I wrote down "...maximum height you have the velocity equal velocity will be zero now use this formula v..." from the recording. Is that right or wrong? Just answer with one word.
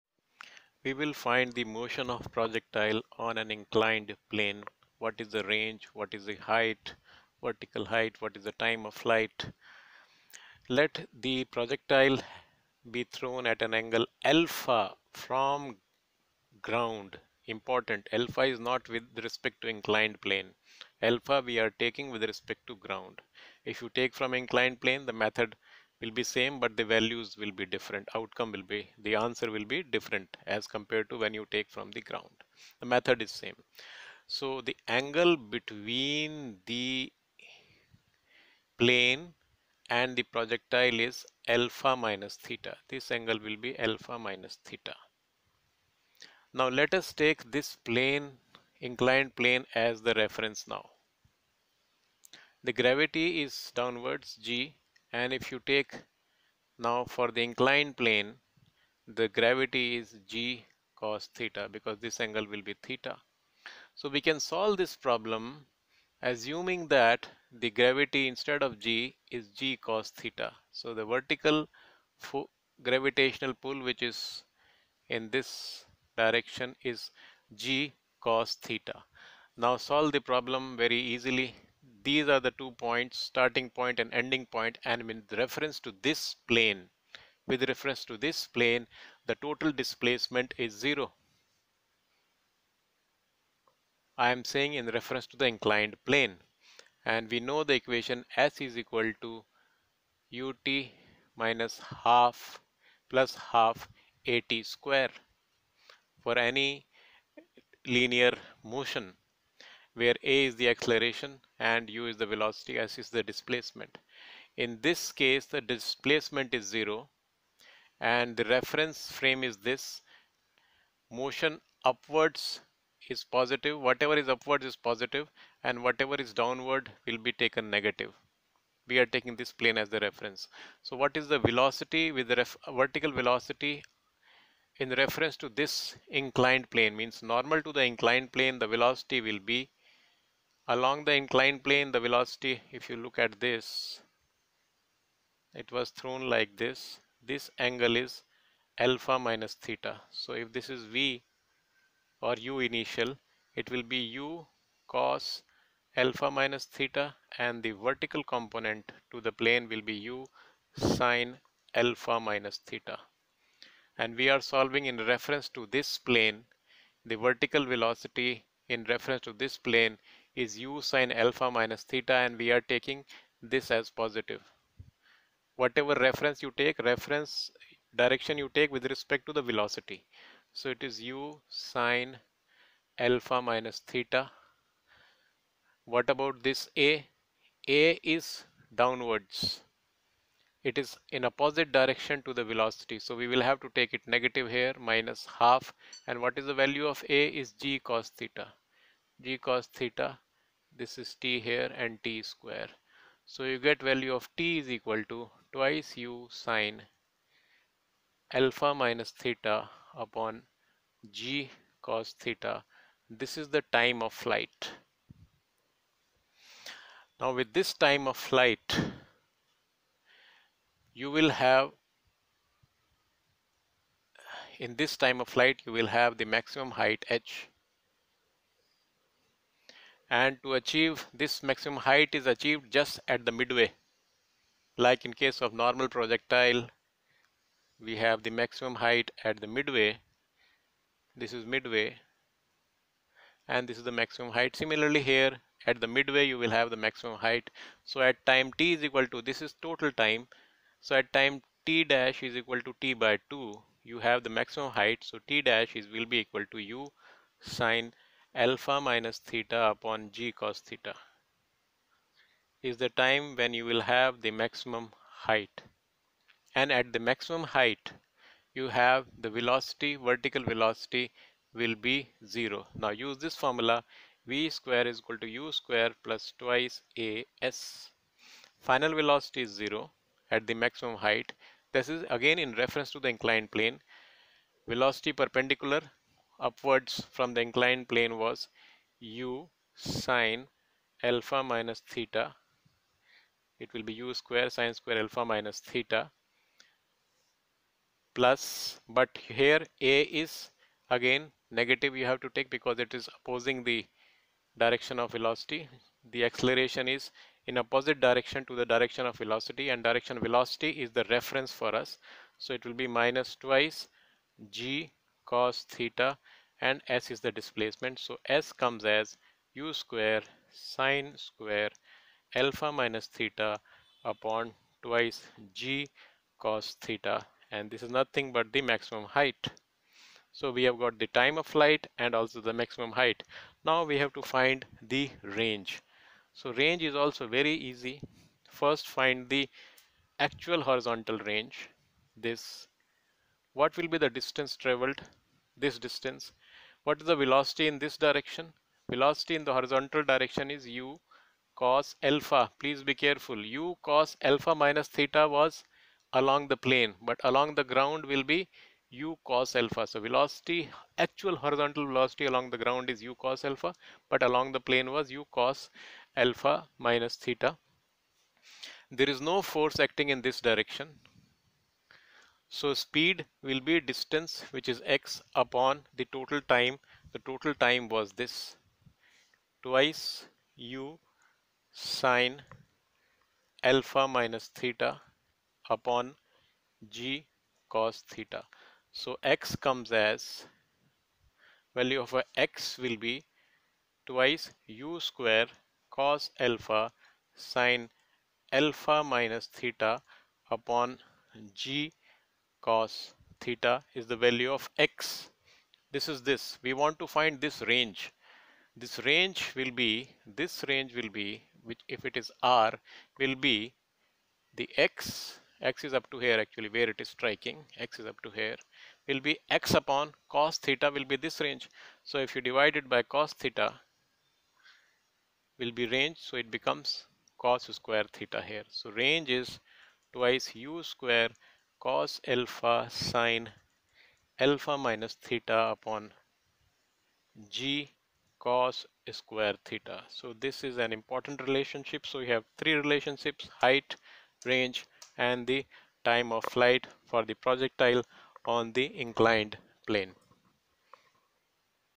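wrong.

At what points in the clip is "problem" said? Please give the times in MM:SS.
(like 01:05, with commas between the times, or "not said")
01:04, 01:20.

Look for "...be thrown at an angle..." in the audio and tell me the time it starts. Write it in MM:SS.
00:12.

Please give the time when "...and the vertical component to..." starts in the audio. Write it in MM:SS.
02:37.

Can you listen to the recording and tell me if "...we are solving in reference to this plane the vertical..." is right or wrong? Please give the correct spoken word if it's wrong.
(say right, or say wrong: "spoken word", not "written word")
right.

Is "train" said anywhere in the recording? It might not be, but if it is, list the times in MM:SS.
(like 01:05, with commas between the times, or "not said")
not said.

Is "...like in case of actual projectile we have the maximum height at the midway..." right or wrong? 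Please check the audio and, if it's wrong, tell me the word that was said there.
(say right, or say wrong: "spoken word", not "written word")
wrong: "normal", not "actual".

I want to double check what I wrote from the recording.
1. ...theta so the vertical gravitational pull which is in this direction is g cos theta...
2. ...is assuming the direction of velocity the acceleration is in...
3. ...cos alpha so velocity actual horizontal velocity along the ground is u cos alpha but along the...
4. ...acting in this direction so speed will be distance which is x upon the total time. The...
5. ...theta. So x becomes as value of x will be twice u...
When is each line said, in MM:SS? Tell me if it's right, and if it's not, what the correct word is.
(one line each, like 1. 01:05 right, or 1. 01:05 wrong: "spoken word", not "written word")
1. 01:10 right
2. 05:03 wrong: "opposing", not "assuming"
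3. 05:59 right
4. 06:09 right
5. 06:28 wrong: "comes", not "becomes".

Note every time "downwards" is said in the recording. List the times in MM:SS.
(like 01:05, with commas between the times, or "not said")
00:53, 02:06, 03:08.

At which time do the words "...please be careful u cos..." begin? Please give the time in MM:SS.
05:52.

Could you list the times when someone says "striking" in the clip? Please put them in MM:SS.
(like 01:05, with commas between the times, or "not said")
06:57.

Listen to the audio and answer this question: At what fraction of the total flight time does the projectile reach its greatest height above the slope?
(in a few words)
t/2.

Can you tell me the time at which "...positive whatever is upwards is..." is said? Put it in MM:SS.
02:03.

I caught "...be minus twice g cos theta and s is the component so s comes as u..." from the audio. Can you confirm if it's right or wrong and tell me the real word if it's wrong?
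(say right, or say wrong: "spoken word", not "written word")
wrong: "displacement", not "component".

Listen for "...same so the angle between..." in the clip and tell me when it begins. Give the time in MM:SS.
00:33.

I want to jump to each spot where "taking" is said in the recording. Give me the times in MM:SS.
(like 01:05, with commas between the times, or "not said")
00:21, 02:09, 02:52.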